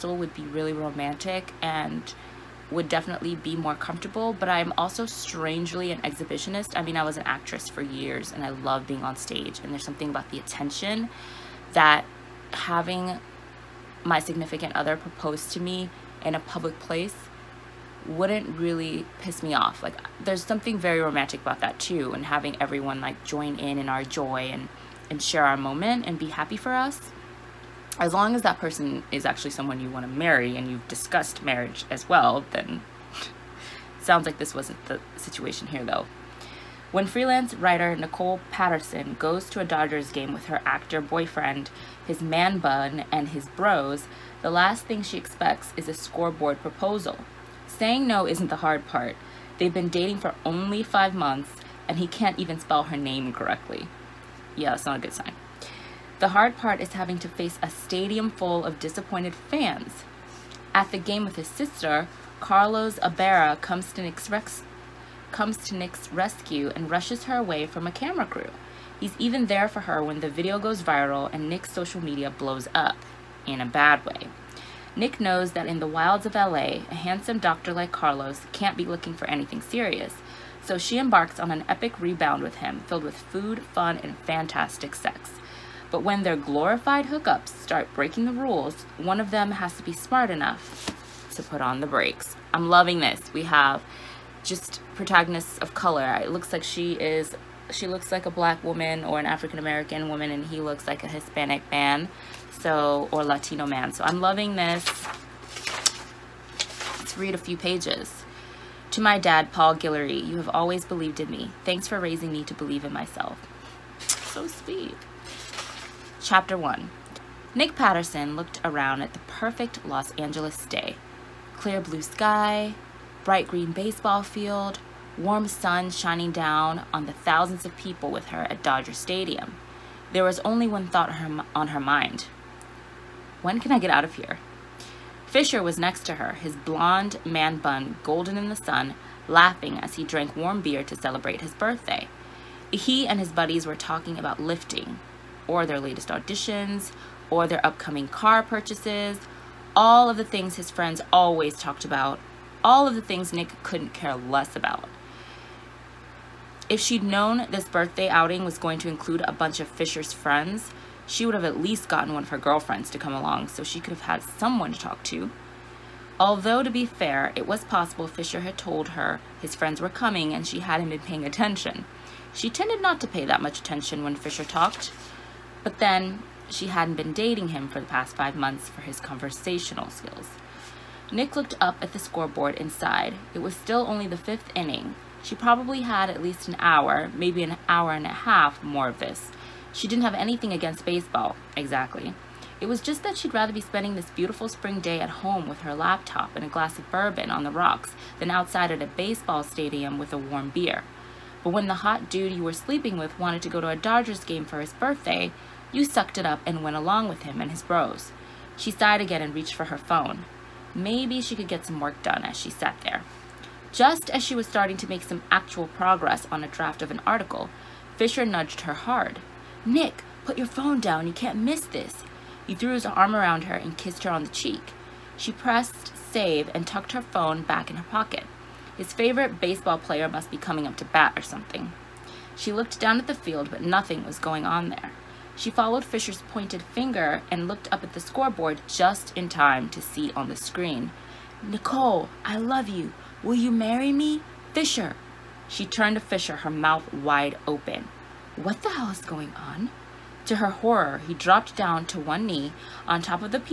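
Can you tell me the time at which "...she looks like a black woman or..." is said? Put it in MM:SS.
01:37.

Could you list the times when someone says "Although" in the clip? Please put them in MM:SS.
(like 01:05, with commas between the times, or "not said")
02:46.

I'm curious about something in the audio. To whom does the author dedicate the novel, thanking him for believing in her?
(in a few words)
Paul Guillory.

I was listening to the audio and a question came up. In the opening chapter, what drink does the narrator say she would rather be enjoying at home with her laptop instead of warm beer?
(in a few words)
bourbon on the rocks.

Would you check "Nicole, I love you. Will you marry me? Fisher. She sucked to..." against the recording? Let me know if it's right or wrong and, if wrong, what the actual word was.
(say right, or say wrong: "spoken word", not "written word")
wrong: "turned", not "sucked".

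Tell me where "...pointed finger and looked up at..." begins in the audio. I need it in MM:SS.
03:56.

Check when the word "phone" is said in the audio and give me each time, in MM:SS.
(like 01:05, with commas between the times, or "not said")
03:29, 03:40, 03:47.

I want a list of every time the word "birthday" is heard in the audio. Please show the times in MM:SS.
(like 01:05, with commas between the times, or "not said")
02:21, 02:37, 03:24.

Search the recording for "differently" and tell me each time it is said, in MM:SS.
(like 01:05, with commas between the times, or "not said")
not said.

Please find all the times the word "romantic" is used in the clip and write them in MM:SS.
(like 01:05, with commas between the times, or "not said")
00:00, 00:20.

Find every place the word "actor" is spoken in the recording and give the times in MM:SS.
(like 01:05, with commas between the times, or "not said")
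00:40.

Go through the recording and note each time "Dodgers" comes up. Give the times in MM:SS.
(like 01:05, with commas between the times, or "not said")
00:39, 02:08, 03:23.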